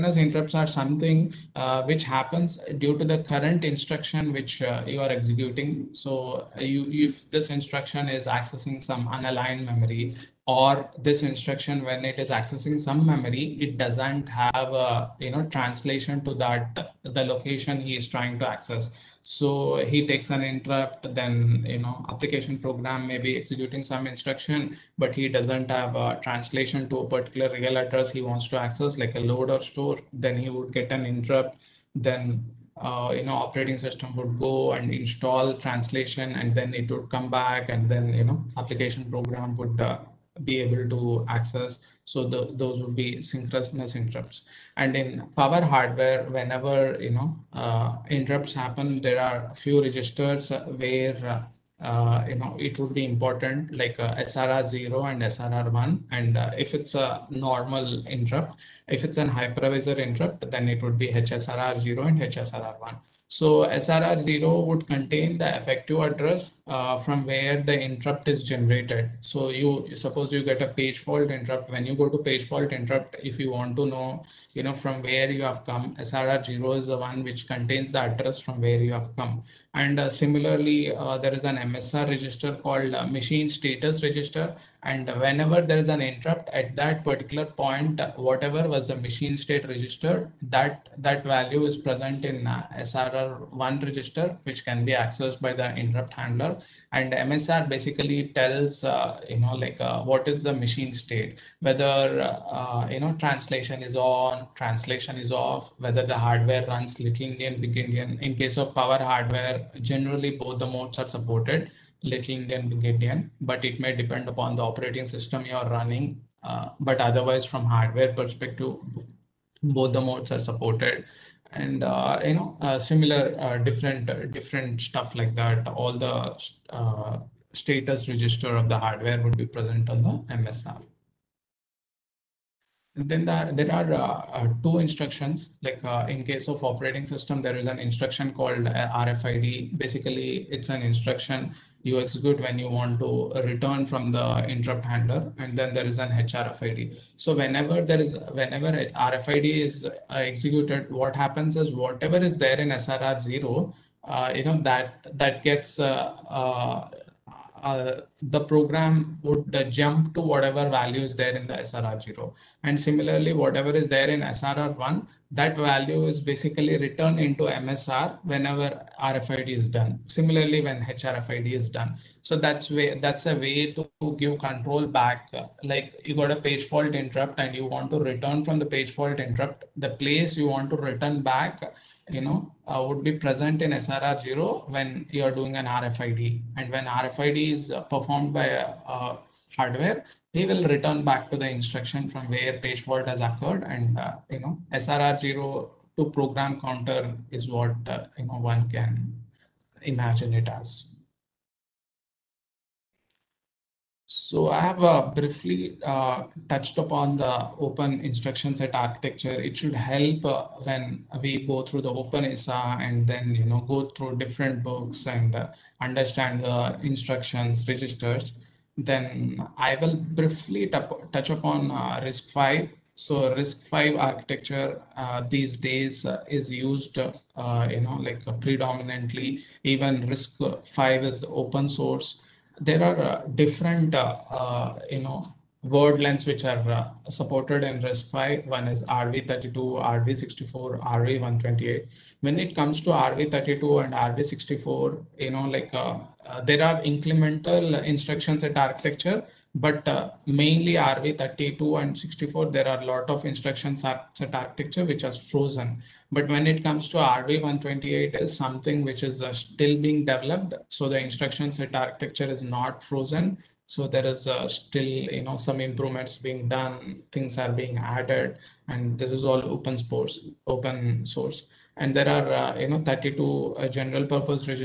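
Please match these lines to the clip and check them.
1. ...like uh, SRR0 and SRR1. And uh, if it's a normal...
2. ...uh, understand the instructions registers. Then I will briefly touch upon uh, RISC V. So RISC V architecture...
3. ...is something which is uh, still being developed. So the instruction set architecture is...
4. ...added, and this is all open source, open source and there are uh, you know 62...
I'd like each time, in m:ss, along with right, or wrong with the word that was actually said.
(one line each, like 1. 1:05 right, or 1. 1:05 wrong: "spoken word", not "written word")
1. 0:53 right
2. 3:35 right
3. 4:18 right
4. 4:27 wrong: "32", not "62".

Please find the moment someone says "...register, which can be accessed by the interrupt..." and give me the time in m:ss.
1:33.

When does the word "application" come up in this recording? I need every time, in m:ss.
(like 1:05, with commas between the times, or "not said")
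0:22, 0:38.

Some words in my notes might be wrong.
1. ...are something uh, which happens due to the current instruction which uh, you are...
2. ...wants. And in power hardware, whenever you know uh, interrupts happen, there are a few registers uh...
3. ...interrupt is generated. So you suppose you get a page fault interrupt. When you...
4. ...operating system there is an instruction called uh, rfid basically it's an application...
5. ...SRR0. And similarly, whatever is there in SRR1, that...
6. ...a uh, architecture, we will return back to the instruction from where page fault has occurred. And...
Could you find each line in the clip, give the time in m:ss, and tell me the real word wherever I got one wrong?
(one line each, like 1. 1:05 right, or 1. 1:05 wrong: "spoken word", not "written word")
1. 0:00 right
2. 0:43 wrong: "interrupts", not "wants"
3. 1:07 right
4. 2:16 wrong: "instruction", not "application"
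5. 2:41 right
6. 3:08 wrong: "hardware", not "architecture".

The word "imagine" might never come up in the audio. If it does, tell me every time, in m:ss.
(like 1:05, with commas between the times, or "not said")
3:19.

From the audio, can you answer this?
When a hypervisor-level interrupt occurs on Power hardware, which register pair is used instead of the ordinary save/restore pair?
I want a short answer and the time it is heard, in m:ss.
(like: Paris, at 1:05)
HSRR0 and HSRR1, at 1:01.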